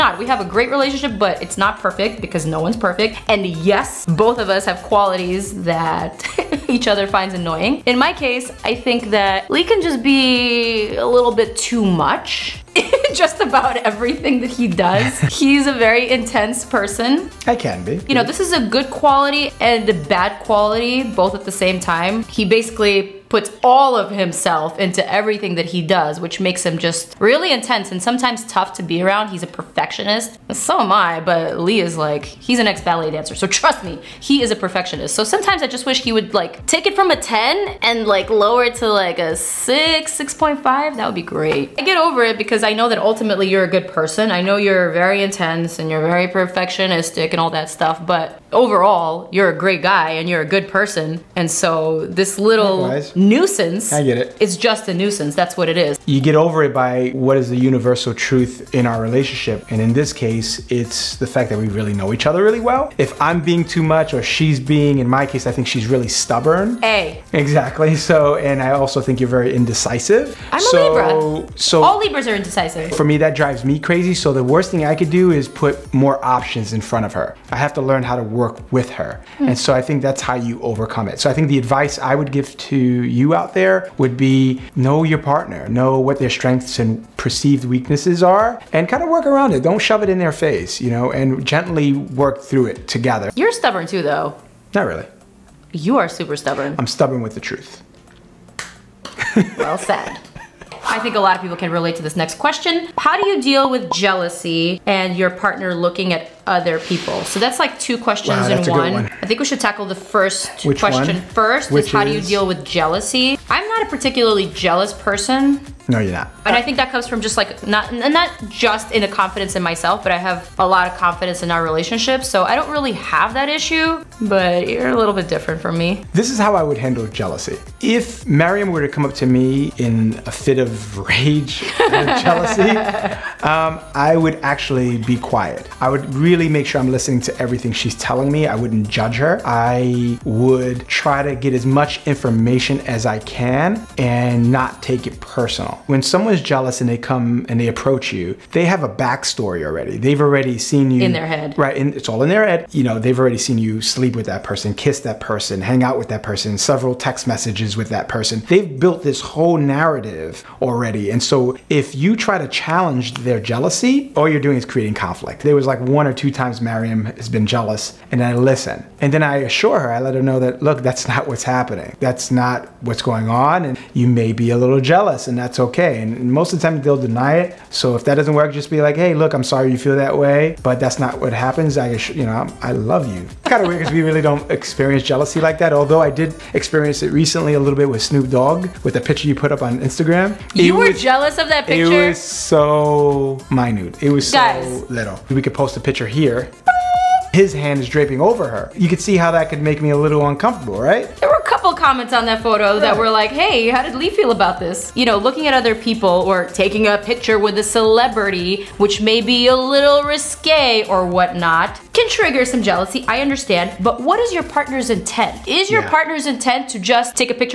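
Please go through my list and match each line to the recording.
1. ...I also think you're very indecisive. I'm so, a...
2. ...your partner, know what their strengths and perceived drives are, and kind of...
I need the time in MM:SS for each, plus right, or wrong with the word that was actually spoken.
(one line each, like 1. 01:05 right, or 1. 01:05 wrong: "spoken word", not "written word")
1. 01:08 right
2. 01:25 wrong: "weaknesses", not "drives".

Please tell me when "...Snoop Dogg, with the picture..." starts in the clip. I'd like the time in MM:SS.
03:08.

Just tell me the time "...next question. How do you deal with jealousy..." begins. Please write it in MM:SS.
01:42.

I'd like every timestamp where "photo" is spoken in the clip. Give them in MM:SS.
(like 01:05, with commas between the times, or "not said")
03:22.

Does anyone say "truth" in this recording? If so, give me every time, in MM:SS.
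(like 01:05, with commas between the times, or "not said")
00:58, 01:37.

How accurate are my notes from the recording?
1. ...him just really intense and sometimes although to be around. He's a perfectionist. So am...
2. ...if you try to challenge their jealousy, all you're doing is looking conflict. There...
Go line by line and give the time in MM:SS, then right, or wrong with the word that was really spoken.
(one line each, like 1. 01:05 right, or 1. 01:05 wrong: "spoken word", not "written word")
1. 00:26 wrong: "tough", not "although"
2. 02:41 wrong: "creating", not "looking".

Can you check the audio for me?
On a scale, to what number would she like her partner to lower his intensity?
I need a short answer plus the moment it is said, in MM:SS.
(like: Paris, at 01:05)
6, at 00:39.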